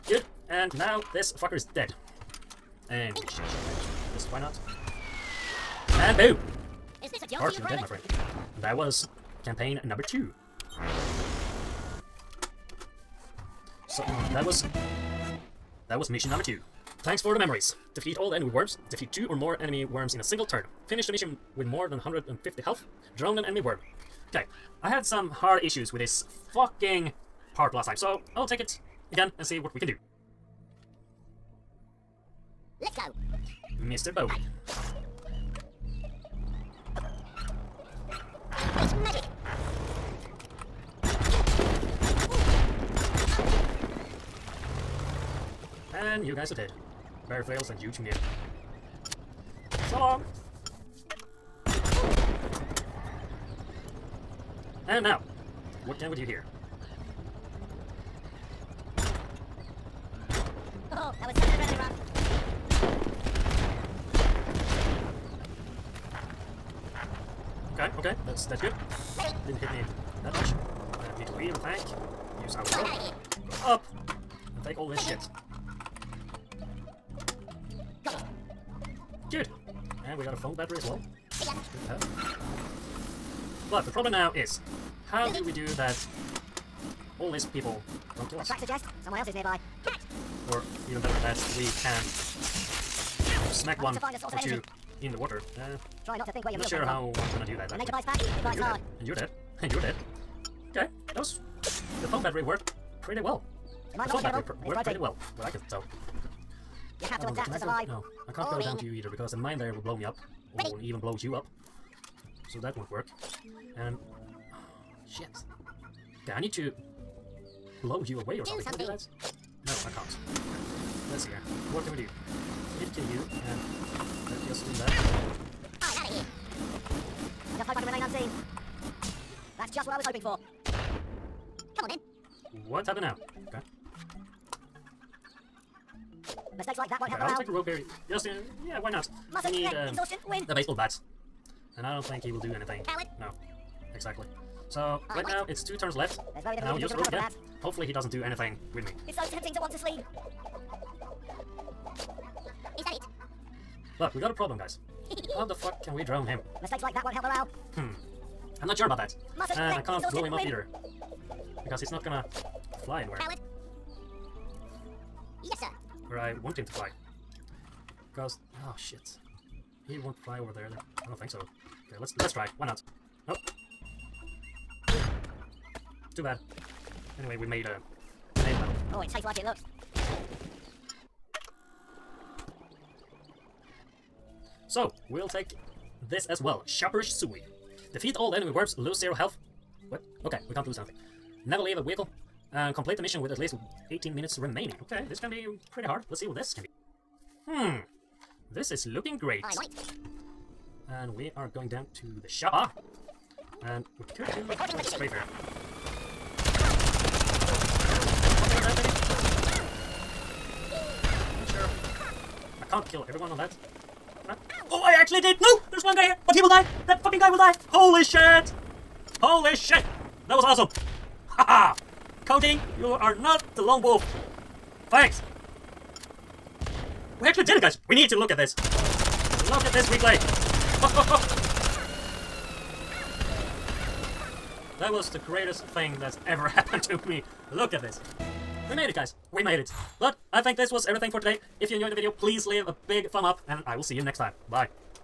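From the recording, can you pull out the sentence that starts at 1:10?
Uh, we need to leave the tank.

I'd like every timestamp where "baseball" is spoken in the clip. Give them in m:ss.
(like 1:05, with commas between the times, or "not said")
2:20.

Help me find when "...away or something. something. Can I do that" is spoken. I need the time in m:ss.
1:58.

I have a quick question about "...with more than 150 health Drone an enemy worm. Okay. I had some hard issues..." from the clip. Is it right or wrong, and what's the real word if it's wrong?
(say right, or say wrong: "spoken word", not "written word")
right.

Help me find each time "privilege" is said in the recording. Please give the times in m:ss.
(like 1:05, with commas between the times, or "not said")
not said.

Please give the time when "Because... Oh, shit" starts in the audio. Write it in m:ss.
2:48.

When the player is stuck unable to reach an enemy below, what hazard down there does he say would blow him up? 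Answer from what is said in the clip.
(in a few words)
The mine.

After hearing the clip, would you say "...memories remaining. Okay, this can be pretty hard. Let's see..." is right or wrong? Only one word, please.
wrong.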